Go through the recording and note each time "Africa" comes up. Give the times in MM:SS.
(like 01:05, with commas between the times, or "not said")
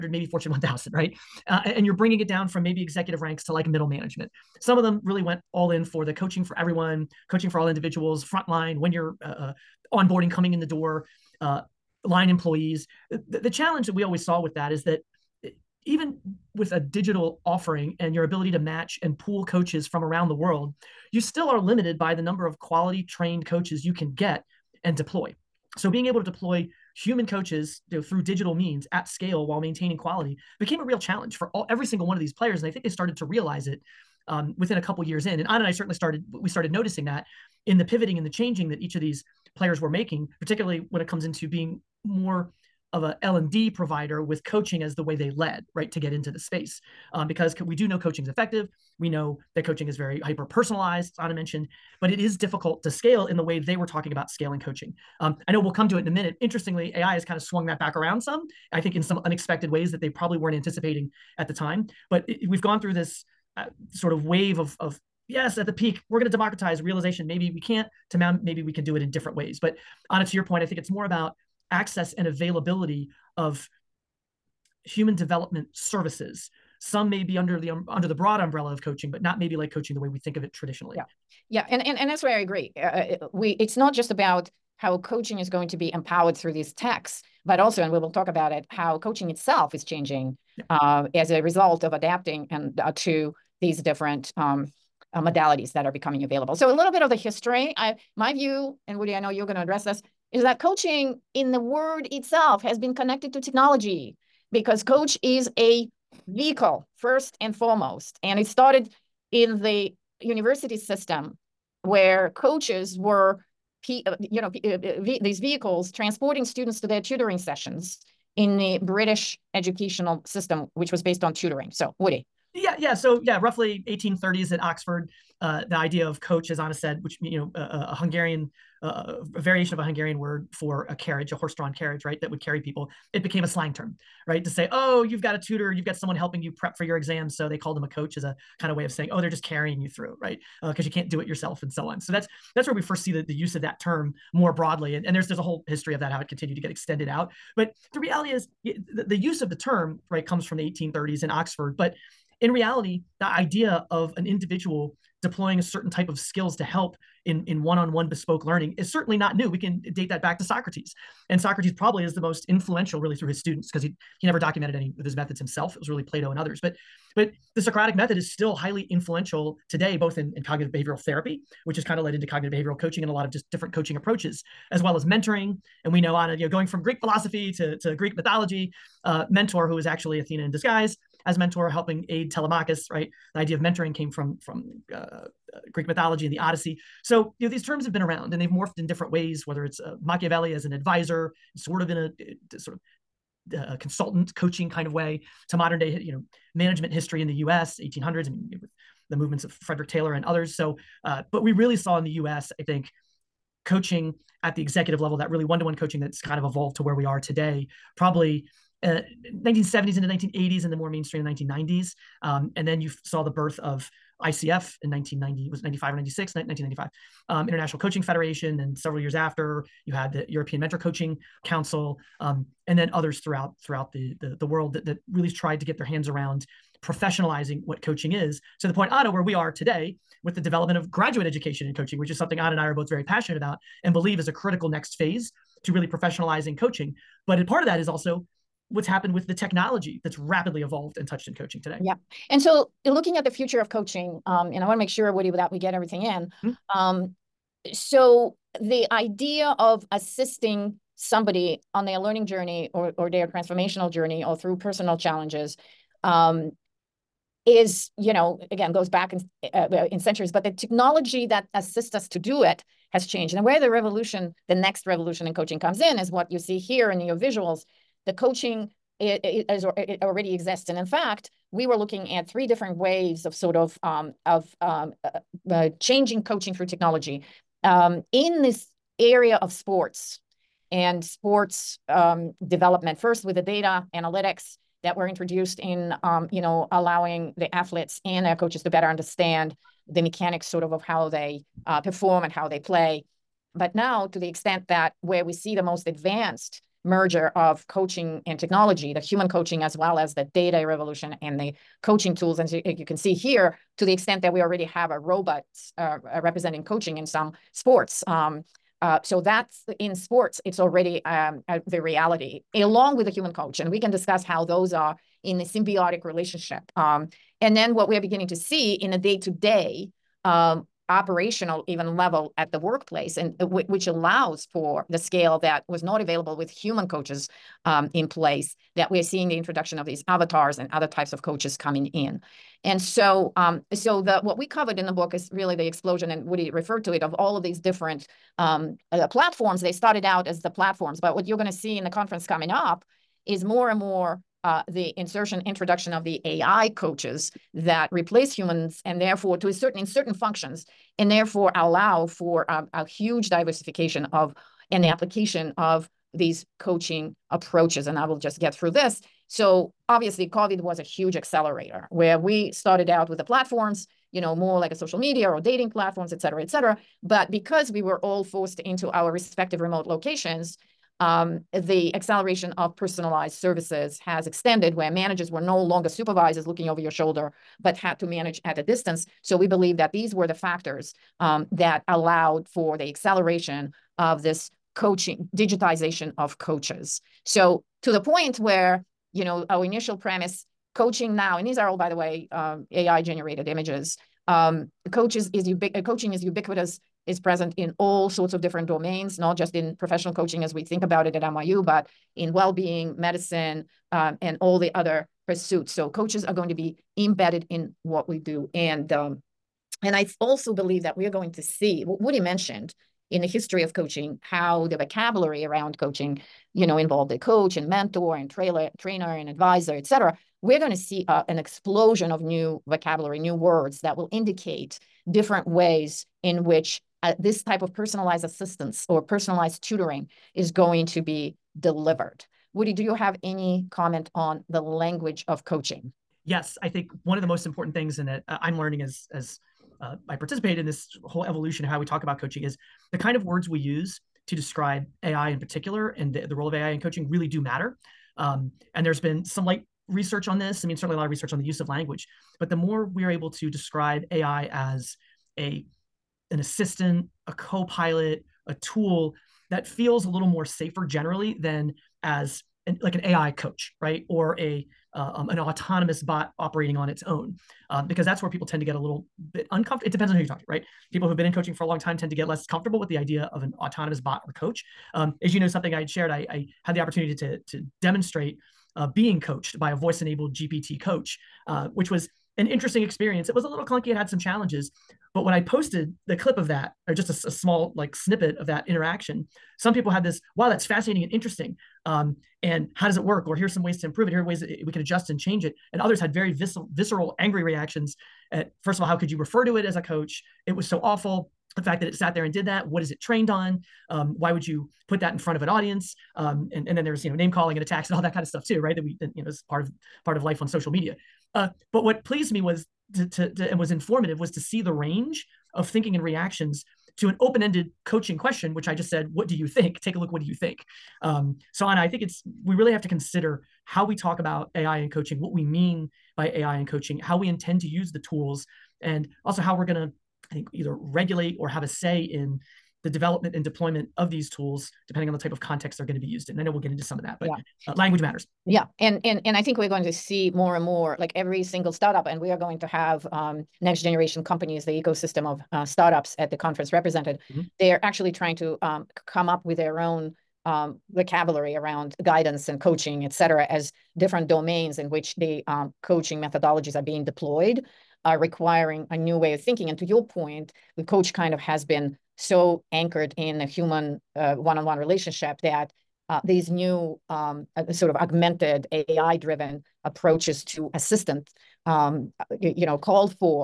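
not said.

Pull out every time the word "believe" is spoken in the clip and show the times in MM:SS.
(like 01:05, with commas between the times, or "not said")
03:53, 06:19, 06:50.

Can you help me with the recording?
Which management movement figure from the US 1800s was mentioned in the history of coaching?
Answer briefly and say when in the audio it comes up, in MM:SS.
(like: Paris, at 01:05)
Frederick Taylor, at 03:19.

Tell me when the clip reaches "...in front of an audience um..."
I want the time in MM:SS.
08:25.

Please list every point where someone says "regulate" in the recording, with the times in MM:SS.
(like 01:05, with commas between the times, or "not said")
08:50.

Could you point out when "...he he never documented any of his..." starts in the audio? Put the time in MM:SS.
02:43.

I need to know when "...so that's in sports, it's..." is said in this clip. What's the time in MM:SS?
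05:09.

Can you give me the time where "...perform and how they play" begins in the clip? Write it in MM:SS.
04:51.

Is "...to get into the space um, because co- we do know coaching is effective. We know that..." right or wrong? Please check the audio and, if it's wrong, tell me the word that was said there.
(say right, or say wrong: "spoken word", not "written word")
right.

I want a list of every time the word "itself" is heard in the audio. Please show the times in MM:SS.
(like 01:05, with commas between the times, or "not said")
01:29, 01:42.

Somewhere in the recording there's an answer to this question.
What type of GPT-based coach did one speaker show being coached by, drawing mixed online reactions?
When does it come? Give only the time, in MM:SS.
07:59.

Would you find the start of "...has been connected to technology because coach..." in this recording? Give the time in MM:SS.
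01:42.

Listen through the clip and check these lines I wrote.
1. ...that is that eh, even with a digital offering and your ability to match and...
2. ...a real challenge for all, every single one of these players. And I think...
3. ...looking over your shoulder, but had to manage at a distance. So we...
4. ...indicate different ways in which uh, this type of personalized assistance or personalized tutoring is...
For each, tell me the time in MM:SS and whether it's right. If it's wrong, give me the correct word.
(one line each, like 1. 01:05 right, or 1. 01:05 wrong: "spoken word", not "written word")
1. 00:14 right
2. 00:30 right
3. 06:16 right
4. 07:04 right.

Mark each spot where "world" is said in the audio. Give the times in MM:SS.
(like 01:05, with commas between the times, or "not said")
00:20, 03:44.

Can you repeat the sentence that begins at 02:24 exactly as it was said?
And, and there's there's a whole history of that, how it continued to get extended out.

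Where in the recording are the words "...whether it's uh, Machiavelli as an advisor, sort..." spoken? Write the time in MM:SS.
03:09.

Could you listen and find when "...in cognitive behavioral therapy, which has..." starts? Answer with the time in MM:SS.
02:50.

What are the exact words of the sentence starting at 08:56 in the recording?
And I know we'll get into some of that, but yeah.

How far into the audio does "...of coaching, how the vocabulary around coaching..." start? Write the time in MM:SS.
06:53.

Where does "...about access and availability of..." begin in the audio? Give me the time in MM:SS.
01:11.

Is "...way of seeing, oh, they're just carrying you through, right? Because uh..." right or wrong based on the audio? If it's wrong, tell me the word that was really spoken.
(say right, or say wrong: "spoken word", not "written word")
wrong: "saying", not "seeing".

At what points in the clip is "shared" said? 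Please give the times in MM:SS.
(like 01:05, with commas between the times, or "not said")
07:55.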